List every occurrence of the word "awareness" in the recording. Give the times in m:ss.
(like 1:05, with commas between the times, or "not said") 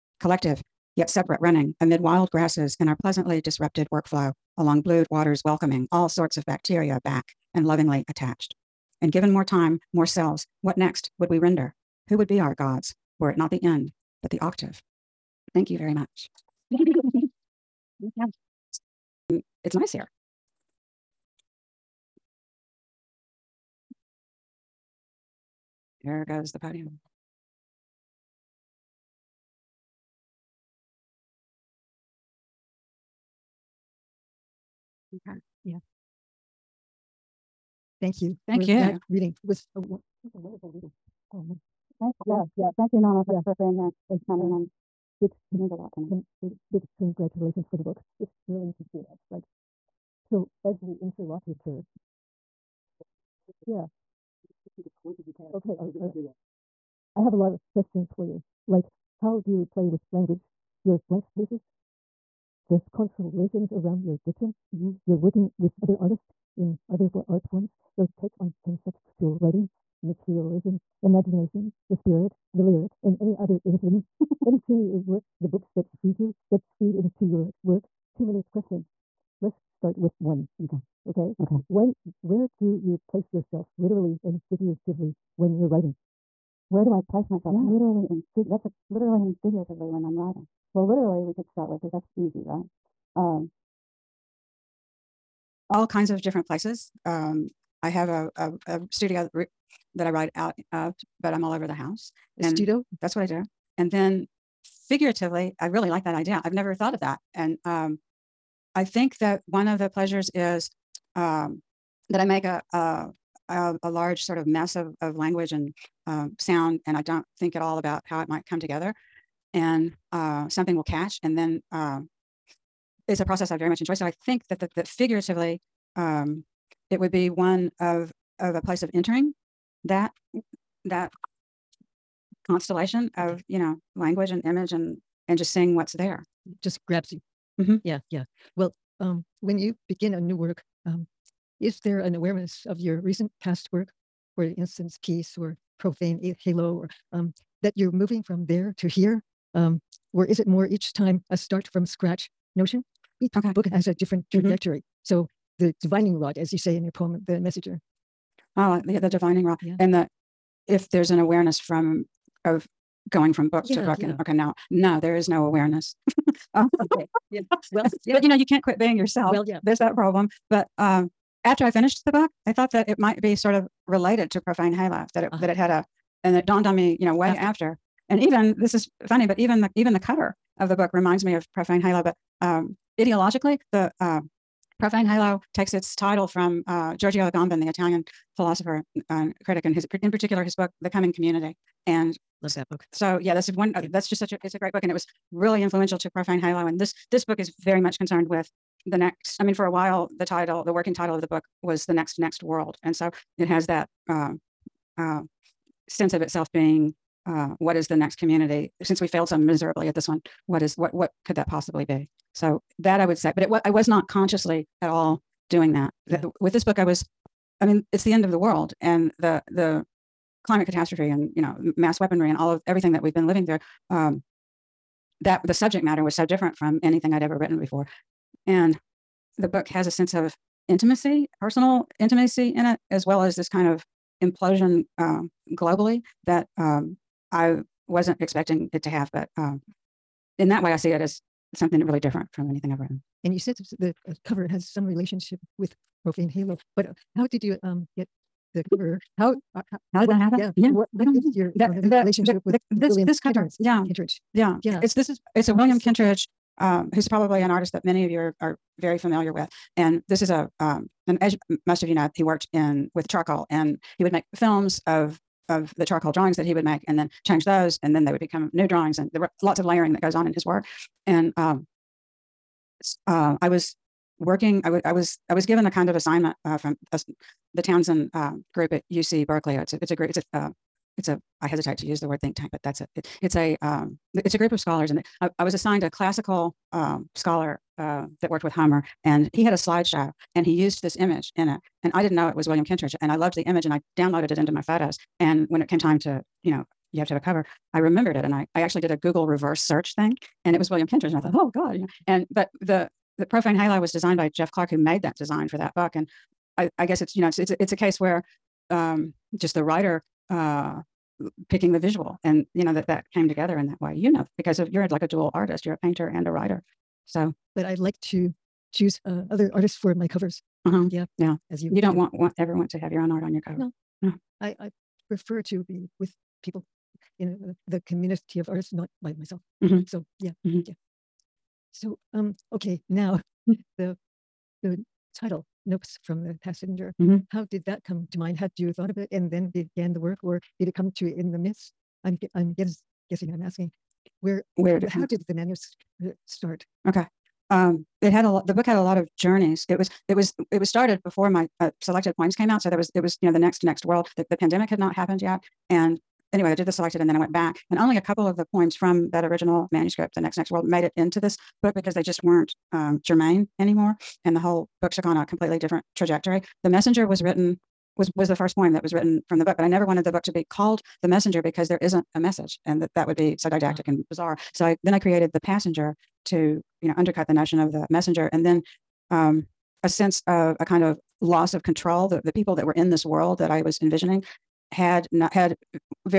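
2:22, 2:41, 2:45.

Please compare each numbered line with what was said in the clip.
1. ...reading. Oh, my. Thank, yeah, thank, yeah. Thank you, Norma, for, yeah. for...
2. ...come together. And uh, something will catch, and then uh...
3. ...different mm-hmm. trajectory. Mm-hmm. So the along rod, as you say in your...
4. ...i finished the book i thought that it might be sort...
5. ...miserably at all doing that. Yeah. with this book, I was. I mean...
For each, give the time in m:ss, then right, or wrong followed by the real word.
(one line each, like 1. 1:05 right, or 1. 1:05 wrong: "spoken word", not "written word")
1. 0:40 right
2. 1:58 right
3. 2:33 wrong: "divining", not "along"
4. 2:51 right
5. 3:34 wrong: "consciously", not "miserably".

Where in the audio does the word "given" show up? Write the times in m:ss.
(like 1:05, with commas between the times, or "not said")
0:09, 4:35.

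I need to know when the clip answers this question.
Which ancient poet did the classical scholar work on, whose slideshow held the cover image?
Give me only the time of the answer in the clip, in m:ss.
4:48.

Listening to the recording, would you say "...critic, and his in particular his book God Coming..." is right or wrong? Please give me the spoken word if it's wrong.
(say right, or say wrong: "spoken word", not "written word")
wrong: "The", not "God".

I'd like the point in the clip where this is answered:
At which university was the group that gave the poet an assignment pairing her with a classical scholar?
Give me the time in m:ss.
4:38.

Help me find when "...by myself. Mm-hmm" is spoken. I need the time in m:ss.
5:29.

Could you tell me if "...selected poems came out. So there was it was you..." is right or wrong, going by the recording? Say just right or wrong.
right.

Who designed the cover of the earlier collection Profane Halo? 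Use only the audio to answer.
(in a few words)
Jeff Clark.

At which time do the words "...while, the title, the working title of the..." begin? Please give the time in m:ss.
3:19.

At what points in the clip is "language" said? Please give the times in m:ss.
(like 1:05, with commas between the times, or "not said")
1:00, 1:55, 2:13.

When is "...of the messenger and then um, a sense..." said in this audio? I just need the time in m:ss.
6:17.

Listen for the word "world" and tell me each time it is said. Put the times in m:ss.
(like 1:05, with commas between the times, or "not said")
3:22, 3:38, 5:53, 6:00, 6:23.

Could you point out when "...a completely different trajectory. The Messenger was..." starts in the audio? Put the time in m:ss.
6:05.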